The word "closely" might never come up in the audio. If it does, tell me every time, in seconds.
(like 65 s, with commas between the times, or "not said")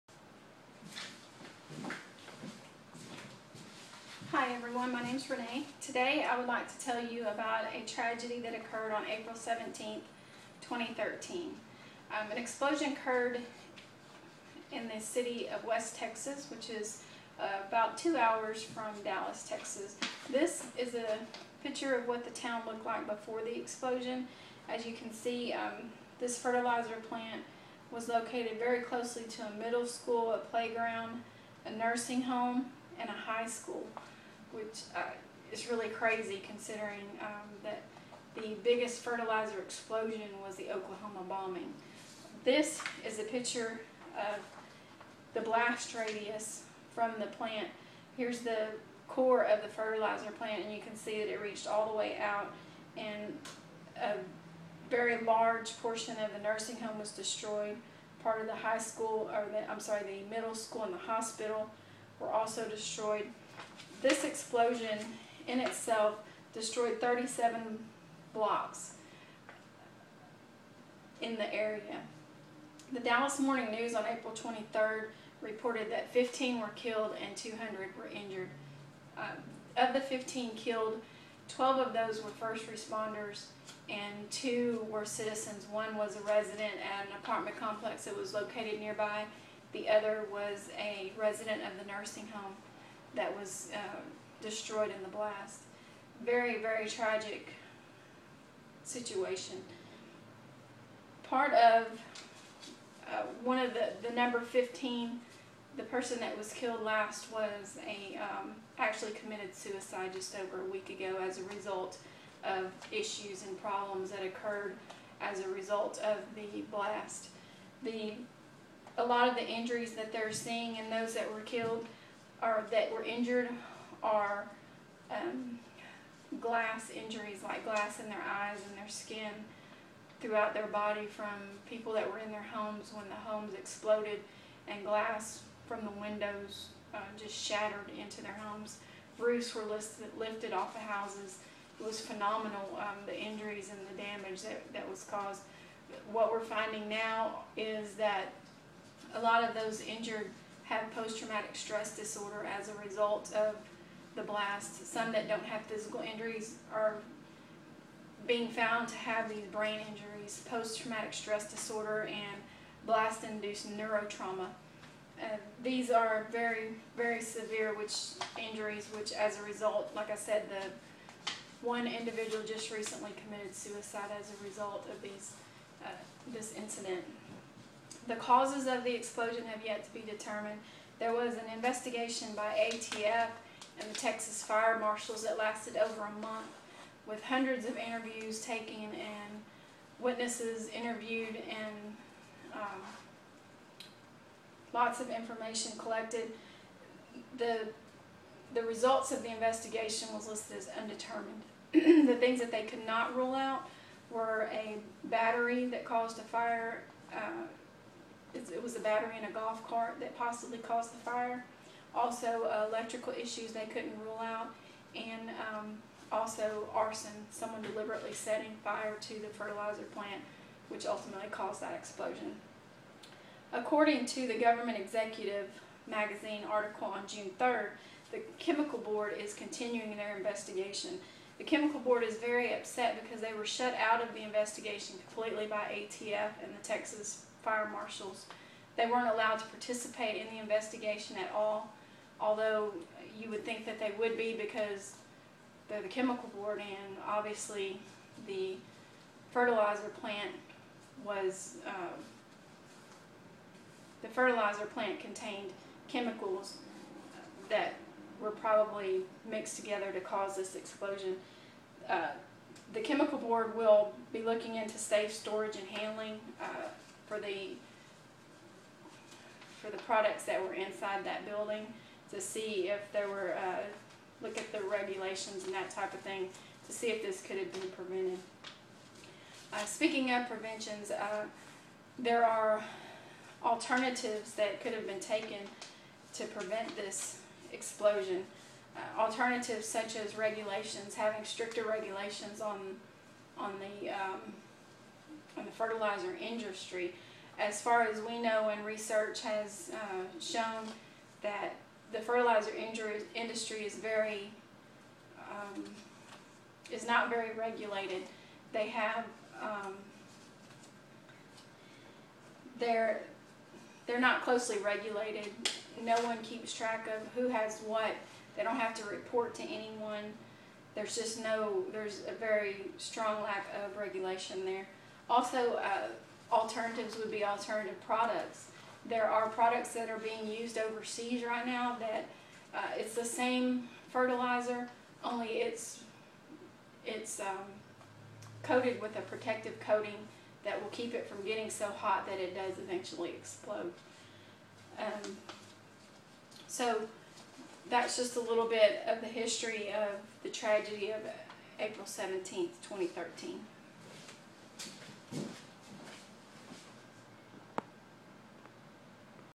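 28 s, 314 s.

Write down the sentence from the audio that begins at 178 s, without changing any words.
The causes of the explosion have yet to be determined.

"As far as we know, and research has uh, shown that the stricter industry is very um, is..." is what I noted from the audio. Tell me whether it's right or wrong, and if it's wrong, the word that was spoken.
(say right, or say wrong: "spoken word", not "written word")
wrong: "fertilizer", not "stricter".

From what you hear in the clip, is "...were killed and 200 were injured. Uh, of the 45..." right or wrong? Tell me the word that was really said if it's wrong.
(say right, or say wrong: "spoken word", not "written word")
wrong: "15", not "45".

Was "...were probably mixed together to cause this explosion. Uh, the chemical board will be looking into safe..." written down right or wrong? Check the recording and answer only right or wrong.
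right.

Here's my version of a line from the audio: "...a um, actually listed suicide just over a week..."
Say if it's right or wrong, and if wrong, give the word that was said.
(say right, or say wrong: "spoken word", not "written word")
wrong: "committed", not "listed".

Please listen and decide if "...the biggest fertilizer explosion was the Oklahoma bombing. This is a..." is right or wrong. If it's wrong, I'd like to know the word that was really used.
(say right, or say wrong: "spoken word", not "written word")
right.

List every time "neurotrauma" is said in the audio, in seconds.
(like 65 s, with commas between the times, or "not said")
163 s.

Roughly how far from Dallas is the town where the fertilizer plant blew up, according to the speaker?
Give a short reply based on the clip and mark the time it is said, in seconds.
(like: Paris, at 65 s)
2 hours, at 17 s.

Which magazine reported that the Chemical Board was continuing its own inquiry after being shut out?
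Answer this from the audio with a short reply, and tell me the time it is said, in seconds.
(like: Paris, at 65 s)
Government Executive, at 224 s.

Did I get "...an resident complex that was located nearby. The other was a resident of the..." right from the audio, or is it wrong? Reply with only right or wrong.
wrong.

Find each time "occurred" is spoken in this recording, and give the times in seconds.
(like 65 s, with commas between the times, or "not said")
8 s, 12 s, 114 s.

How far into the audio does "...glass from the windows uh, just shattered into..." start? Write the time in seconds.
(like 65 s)
134 s.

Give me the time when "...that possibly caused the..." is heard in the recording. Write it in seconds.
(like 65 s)
209 s.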